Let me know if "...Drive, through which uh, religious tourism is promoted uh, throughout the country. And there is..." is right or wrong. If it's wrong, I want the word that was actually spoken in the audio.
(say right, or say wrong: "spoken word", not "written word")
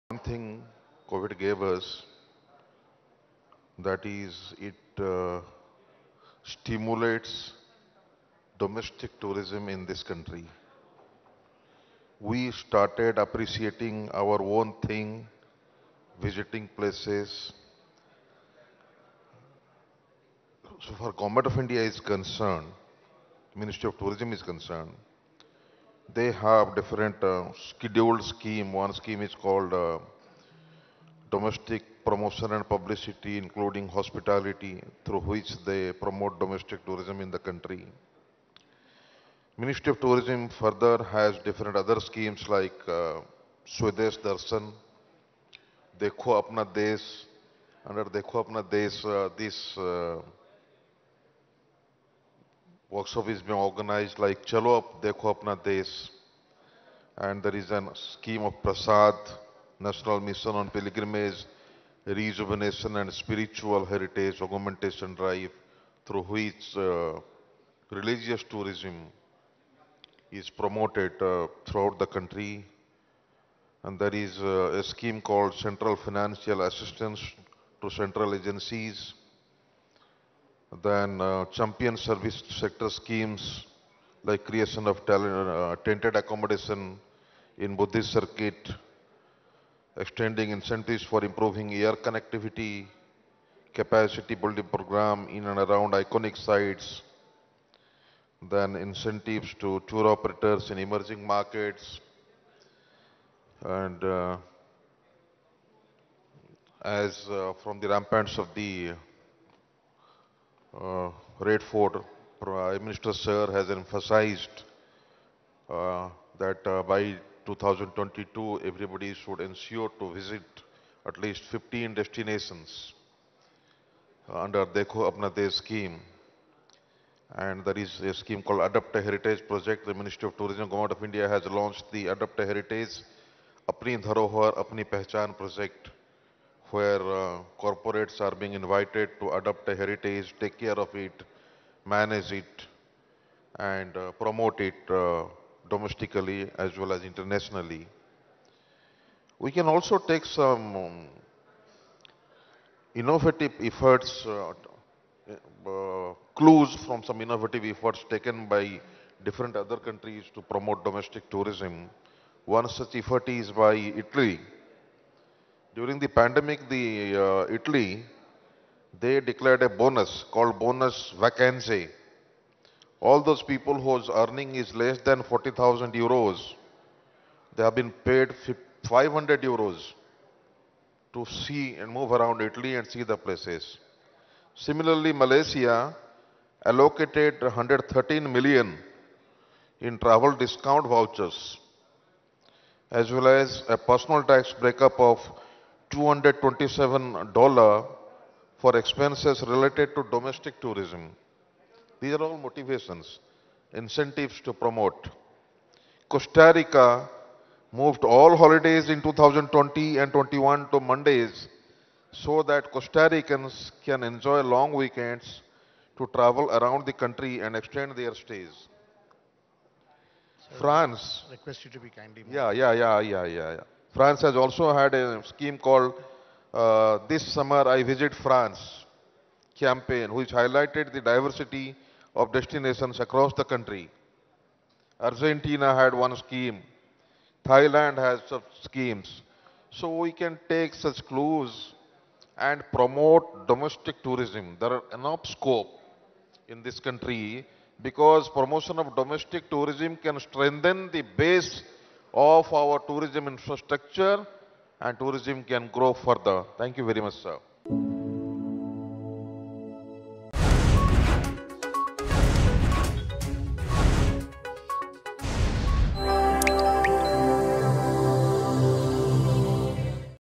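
right.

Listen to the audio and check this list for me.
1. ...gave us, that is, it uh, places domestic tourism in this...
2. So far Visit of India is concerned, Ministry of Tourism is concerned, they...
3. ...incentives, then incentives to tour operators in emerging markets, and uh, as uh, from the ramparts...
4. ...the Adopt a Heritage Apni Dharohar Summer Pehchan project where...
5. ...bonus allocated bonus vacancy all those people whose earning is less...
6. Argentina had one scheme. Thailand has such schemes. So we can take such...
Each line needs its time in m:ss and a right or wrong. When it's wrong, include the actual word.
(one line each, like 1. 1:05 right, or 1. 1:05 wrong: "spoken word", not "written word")
1. 0:01 wrong: "stimulates", not "places"
2. 0:20 wrong: "Government", not "Visit"
3. 1:36 wrong: "sites", not "incentives"
4. 2:11 wrong: "Apni", not "Summer"
5. 2:49 wrong: "called", not "allocated"
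6. 3:54 right.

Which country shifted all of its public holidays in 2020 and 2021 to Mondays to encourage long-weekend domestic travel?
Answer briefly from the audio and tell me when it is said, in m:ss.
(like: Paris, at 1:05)
Costa Rica, at 3:26.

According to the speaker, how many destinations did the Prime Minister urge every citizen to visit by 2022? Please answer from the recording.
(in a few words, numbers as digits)
15.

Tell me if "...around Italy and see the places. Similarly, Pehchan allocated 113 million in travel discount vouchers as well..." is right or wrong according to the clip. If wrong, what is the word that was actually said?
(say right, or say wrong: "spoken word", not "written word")
wrong: "Malaysia", not "Pehchan".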